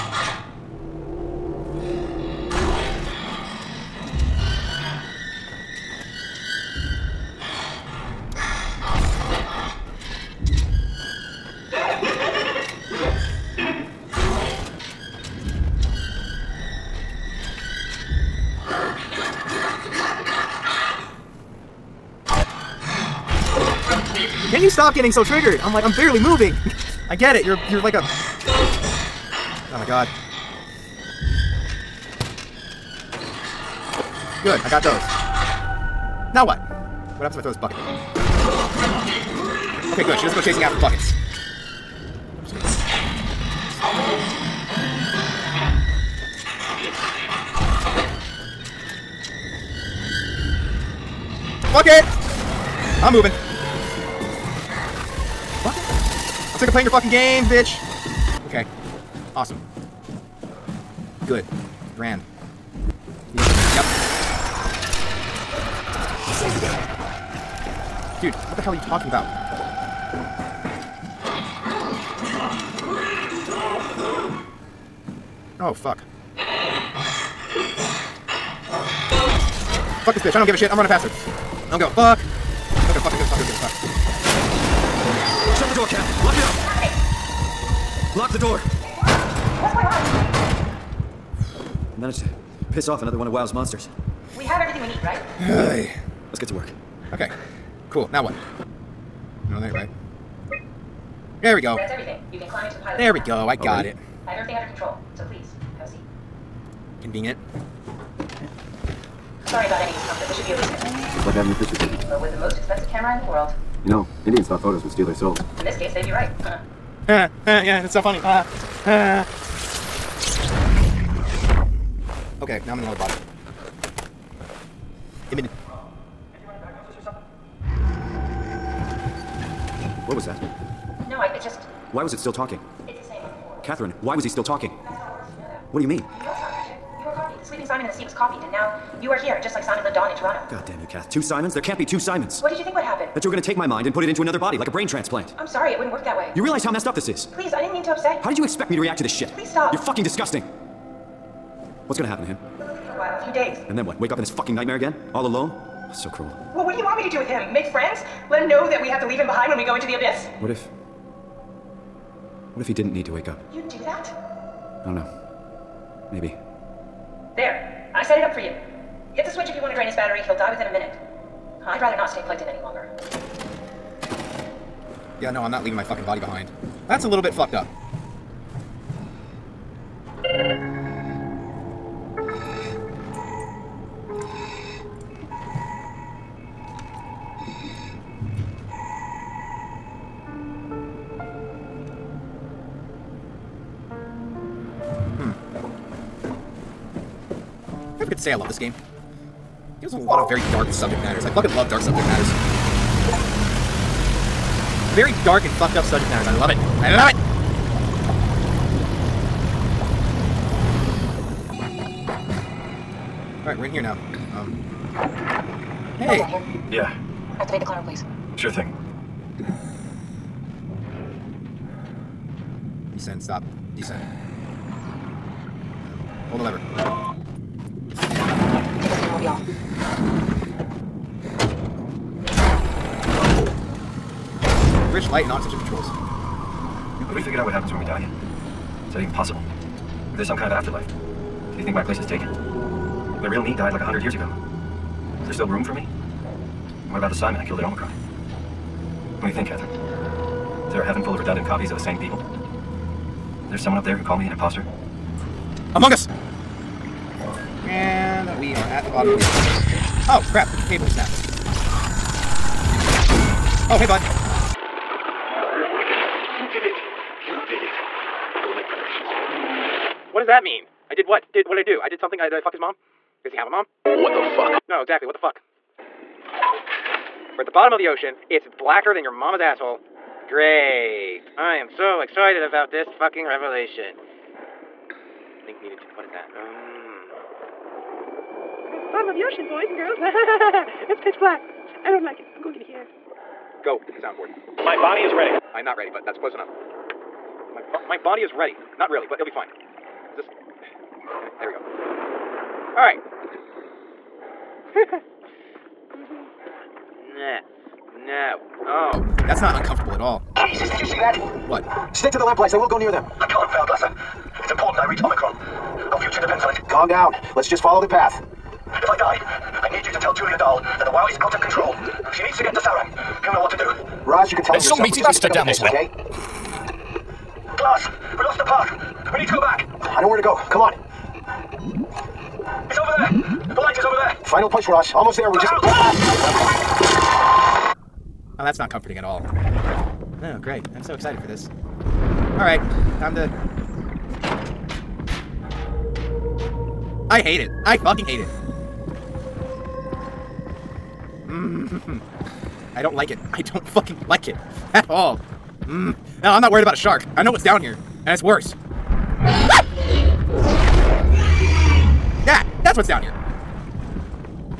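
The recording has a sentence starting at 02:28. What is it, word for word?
How did you expect me to react to this shit?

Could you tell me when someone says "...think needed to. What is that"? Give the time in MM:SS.
04:45.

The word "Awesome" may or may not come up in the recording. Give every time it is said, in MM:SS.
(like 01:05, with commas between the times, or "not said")
00:59.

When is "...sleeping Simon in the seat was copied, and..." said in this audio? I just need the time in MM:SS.
02:17.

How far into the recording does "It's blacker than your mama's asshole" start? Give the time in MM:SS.
04:38.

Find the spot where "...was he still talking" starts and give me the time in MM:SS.
02:14.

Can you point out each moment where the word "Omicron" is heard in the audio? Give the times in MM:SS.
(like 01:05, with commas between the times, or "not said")
04:07, 05:15.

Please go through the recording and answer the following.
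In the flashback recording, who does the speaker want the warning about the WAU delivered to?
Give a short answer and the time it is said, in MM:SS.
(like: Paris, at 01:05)
Julia Dahl, at 05:20.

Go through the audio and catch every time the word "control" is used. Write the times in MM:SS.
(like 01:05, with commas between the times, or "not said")
01:44, 03:55, 05:21.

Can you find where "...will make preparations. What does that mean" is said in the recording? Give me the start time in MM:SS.
04:28.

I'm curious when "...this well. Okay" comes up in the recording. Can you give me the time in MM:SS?
05:25.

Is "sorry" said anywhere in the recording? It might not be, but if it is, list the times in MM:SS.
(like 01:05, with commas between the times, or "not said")
01:49, 02:25.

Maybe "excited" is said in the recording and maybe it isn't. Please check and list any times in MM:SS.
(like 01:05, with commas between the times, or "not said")
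04:42, 05:40.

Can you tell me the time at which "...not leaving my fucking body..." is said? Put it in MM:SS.
02:55.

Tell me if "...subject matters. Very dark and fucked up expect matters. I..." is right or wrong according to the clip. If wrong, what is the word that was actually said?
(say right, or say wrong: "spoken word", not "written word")
wrong: "subject", not "expect".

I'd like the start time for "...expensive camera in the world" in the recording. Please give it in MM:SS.
01:52.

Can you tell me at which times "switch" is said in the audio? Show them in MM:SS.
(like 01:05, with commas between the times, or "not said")
02:49.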